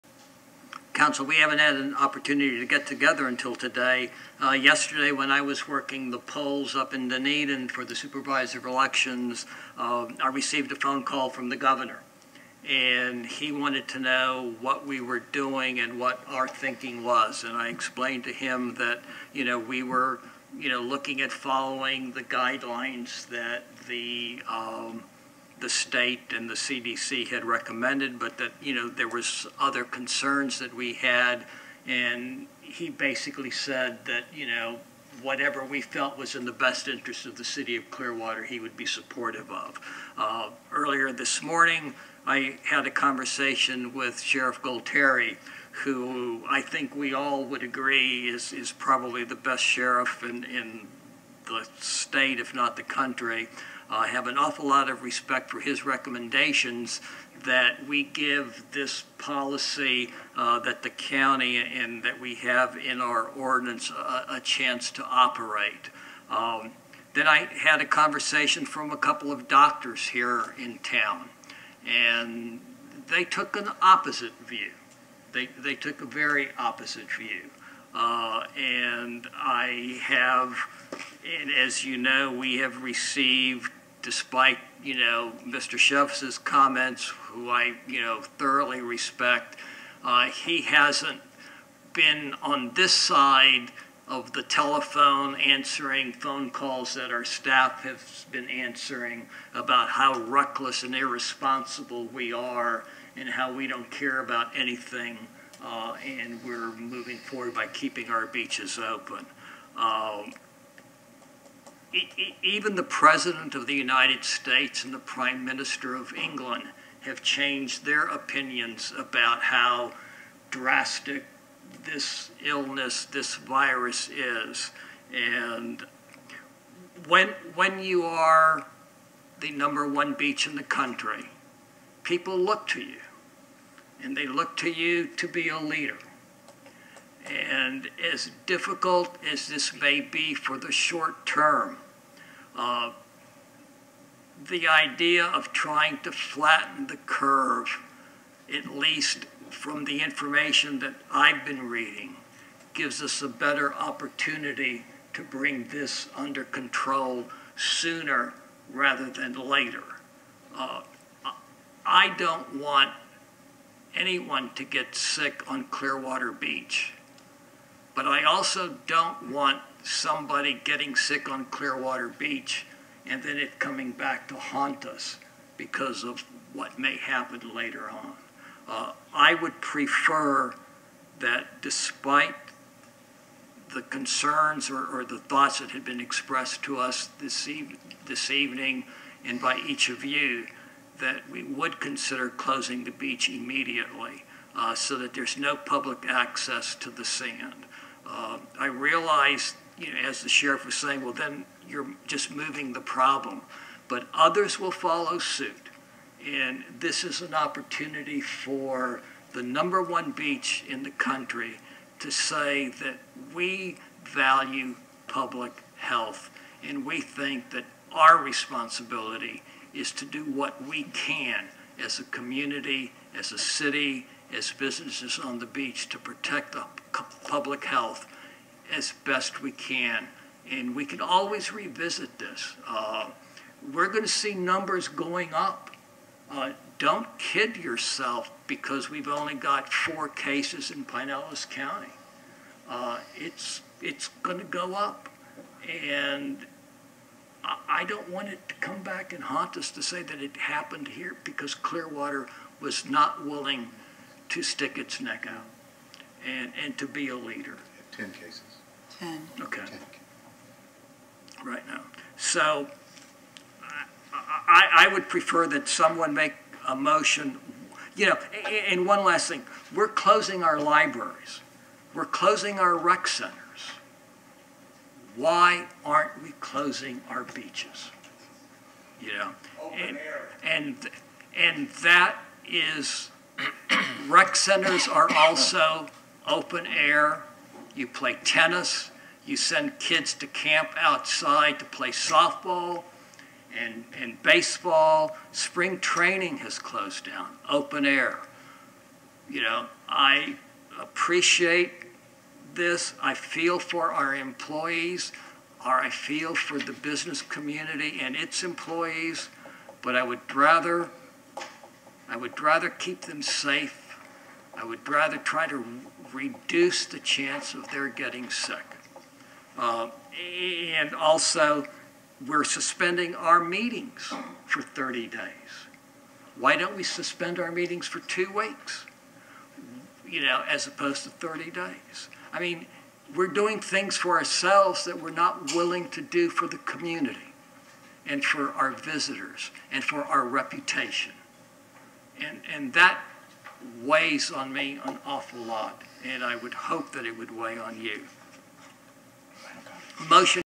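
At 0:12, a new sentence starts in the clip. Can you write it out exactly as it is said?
And he wanted to know what we were doing and what our thinking was.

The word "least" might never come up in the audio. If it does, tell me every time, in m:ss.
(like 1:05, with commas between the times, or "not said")
2:28.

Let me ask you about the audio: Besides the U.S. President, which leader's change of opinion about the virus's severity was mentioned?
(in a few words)
Prime Minister of England.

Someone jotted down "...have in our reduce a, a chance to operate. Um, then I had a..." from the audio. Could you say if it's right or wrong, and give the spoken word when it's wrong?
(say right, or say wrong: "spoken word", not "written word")
wrong: "ordinance", not "reduce".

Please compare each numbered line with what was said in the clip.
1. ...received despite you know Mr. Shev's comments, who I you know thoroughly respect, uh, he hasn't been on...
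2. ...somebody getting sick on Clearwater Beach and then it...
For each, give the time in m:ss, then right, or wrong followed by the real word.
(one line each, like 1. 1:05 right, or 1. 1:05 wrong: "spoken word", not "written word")
1. 1:22 right
2. 2:49 right.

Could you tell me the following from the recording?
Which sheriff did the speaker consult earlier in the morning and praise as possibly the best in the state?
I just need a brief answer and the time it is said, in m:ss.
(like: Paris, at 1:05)
Sheriff Gualtieri, at 0:44.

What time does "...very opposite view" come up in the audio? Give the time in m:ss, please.
1:16.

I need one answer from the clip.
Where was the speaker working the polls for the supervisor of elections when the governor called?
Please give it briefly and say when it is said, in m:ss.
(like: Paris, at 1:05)
Dunedin, at 0:07.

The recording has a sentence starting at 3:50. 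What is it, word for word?
And we can always revisit this.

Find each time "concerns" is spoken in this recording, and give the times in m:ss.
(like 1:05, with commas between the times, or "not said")
0:29, 3:03.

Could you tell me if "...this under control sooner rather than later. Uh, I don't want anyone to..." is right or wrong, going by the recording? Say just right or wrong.
right.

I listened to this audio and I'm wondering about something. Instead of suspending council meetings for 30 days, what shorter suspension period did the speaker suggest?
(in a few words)
2 weeks.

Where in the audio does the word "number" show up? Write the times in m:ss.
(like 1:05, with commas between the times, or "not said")
2:09, 3:29, 3:54.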